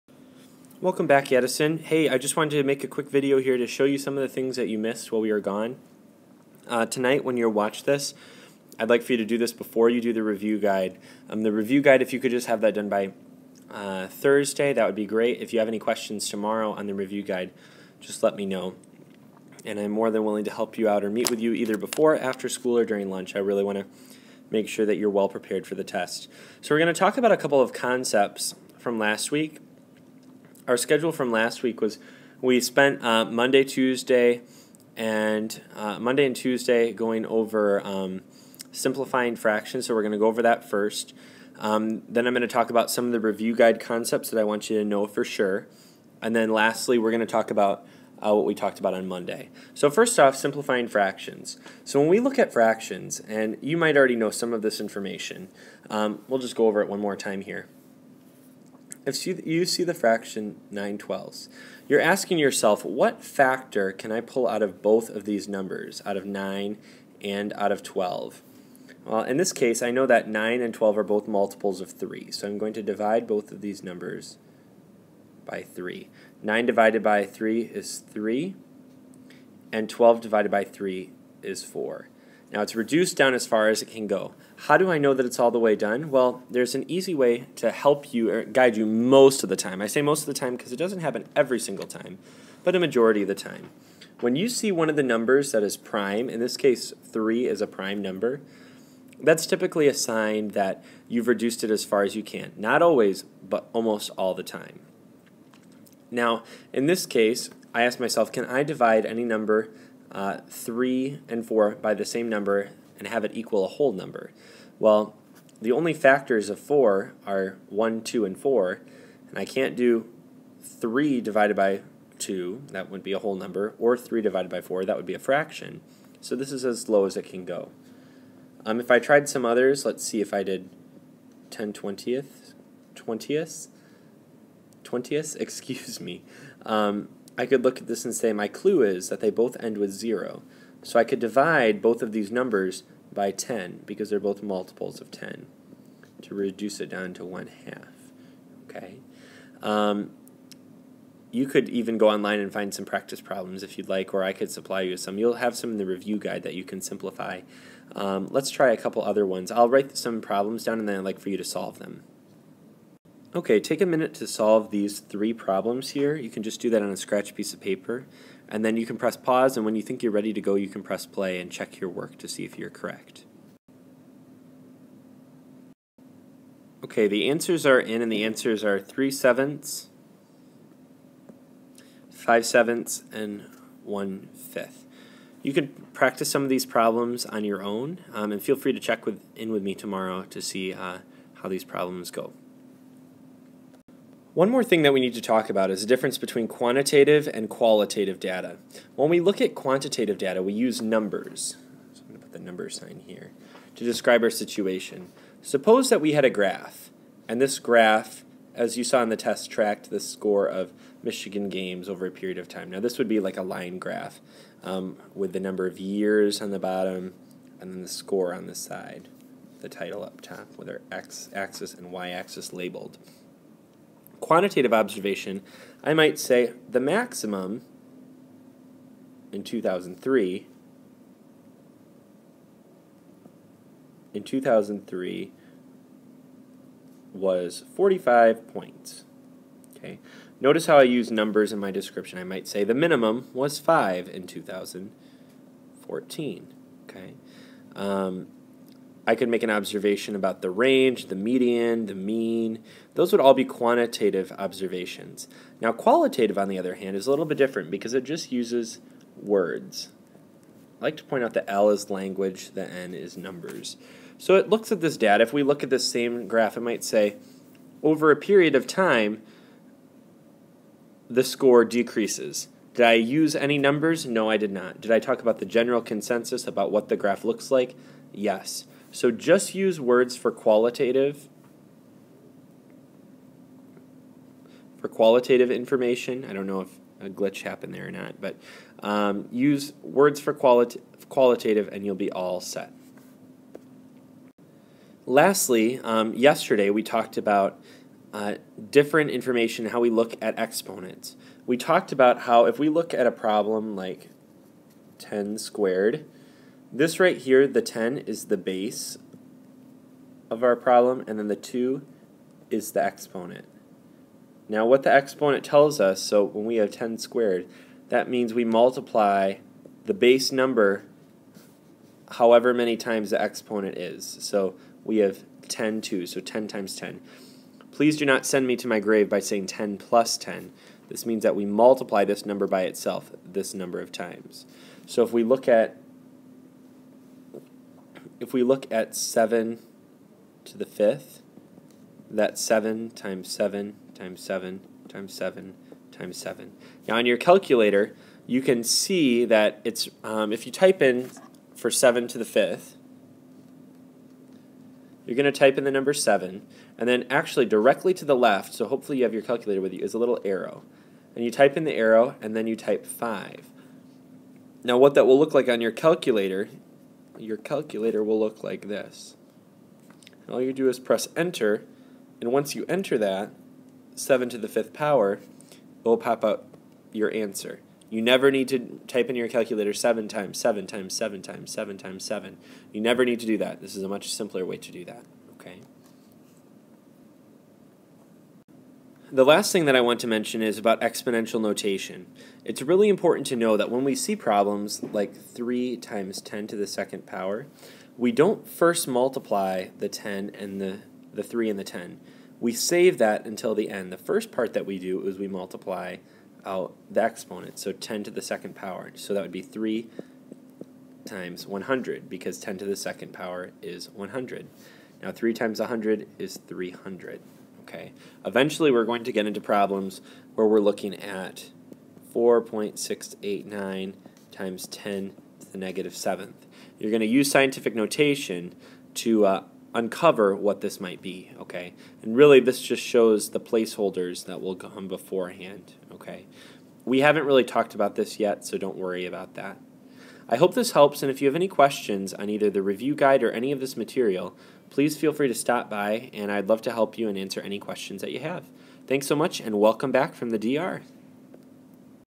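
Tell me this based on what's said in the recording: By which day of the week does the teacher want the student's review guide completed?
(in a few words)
Thursday.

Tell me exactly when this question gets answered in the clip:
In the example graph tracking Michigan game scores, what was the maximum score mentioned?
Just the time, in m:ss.
3:57.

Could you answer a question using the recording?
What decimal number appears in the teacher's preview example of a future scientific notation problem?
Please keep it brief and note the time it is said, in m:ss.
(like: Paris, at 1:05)
4.689, at 7:02.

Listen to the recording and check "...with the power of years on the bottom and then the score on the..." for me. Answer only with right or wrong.
wrong.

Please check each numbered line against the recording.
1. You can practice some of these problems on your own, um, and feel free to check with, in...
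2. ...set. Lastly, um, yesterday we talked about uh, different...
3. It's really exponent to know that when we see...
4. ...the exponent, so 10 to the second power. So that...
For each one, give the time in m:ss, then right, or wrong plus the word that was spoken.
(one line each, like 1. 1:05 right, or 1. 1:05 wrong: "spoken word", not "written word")
1. 3:05 right
2. 4:52 right
3. 6:32 wrong: "important", not "exponent"
4. 6:46 right.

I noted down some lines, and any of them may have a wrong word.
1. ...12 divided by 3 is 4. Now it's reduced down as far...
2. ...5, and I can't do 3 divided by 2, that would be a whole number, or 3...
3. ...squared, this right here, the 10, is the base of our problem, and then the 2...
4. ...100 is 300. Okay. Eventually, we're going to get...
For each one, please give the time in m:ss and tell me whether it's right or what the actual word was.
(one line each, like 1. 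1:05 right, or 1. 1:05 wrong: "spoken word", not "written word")
1. 1:19 right
2. 1:58 wrong: "4", not "5"
3. 5:05 right
4. 6:55 right.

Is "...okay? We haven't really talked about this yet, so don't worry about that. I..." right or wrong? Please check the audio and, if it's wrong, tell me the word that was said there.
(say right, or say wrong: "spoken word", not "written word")
right.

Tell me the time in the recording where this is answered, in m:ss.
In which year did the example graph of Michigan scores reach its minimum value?
4:04.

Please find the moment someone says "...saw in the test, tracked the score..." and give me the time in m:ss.
3:28.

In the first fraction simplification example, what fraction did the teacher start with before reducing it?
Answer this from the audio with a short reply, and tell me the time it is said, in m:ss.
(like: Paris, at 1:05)
9/12, at 1:00.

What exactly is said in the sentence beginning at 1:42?
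Not always, but almost all the time.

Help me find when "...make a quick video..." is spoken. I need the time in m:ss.
0:02.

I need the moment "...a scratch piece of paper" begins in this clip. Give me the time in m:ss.
2:46.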